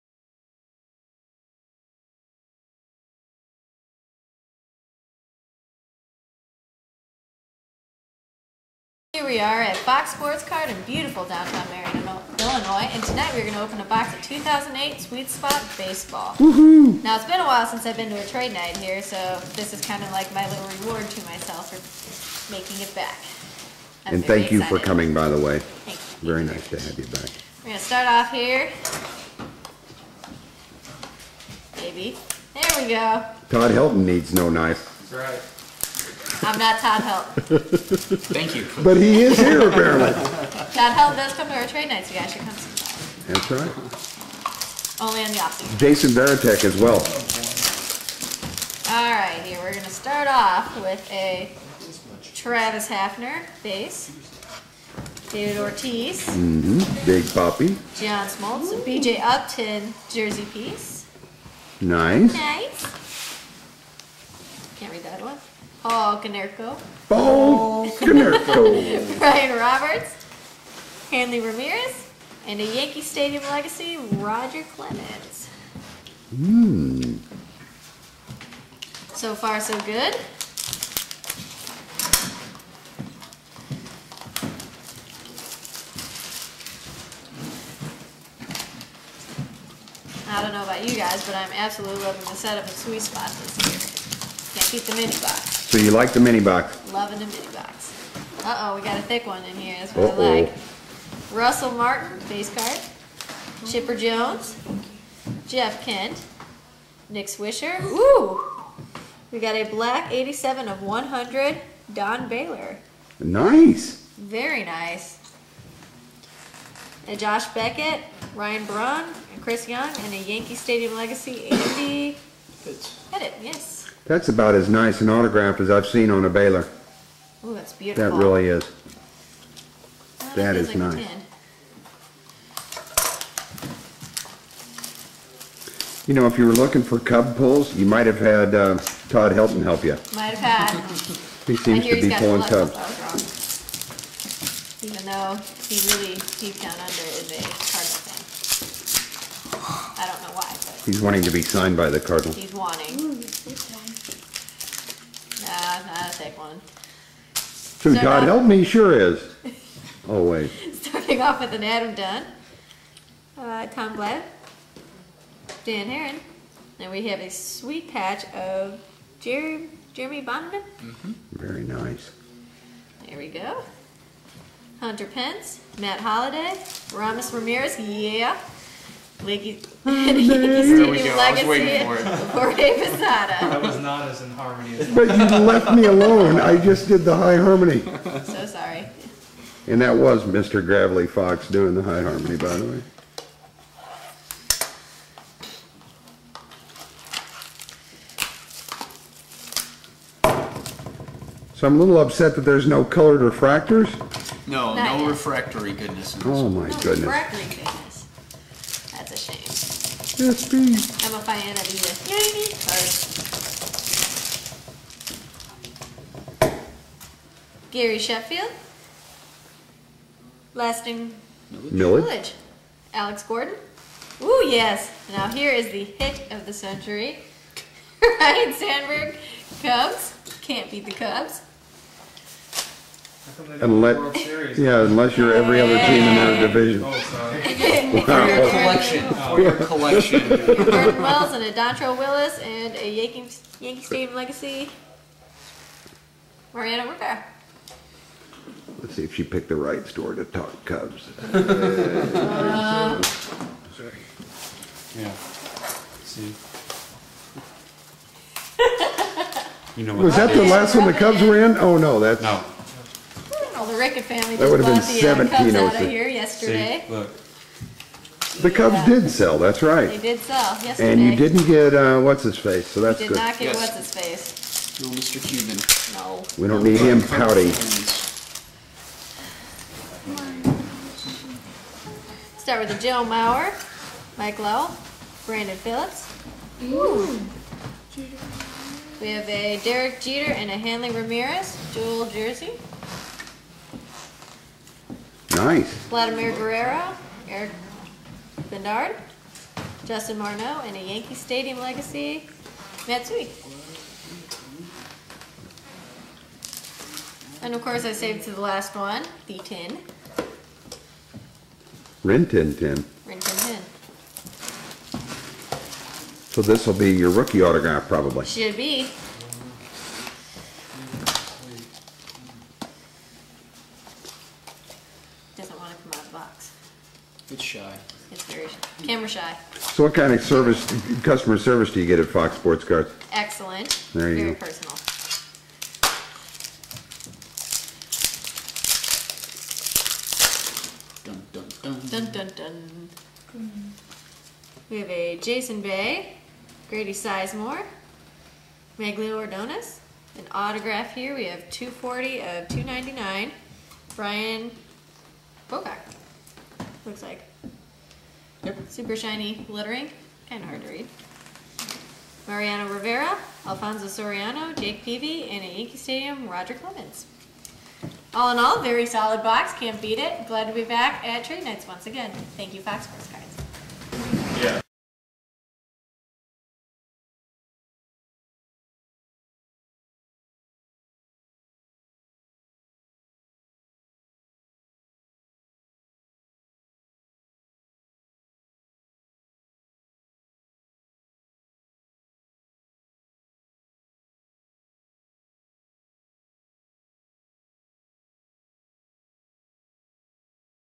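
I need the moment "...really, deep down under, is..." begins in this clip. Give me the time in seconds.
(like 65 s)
145 s.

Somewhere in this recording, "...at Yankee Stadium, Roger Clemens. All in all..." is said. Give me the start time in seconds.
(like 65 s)
365 s.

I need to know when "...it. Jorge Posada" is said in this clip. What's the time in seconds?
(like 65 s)
181 s.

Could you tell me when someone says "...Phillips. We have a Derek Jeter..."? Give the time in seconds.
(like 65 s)
285 s.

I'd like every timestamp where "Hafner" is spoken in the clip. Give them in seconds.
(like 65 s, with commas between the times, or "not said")
52 s.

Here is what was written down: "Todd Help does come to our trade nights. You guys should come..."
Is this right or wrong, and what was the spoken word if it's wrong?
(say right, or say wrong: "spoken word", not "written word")
right.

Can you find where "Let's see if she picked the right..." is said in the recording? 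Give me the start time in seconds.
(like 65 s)
248 s.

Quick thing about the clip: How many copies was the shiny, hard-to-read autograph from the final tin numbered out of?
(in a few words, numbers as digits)
299.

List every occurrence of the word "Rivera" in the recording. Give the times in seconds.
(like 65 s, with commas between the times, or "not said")
246 s, 362 s.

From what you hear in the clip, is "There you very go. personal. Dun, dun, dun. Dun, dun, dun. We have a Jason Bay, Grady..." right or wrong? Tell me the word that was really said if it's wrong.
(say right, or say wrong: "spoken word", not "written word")
right.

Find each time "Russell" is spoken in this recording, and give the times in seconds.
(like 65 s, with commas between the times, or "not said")
101 s.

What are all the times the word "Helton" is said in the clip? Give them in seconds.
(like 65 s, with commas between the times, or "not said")
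33 s, 139 s.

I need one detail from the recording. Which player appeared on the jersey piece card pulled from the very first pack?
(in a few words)
BJ Upton.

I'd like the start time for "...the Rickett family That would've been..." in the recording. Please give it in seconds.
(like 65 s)
263 s.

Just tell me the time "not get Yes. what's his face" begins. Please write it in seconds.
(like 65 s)
273 s.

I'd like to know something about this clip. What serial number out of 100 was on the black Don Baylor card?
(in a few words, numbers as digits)
87.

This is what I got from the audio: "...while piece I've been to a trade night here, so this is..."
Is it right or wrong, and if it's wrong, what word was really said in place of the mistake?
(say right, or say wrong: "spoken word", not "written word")
wrong: "since", not "piece".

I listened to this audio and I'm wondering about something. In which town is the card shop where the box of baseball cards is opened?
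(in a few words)
Marion, Illinois.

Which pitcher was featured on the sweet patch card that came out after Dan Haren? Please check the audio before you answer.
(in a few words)
Jeremy Bonderman.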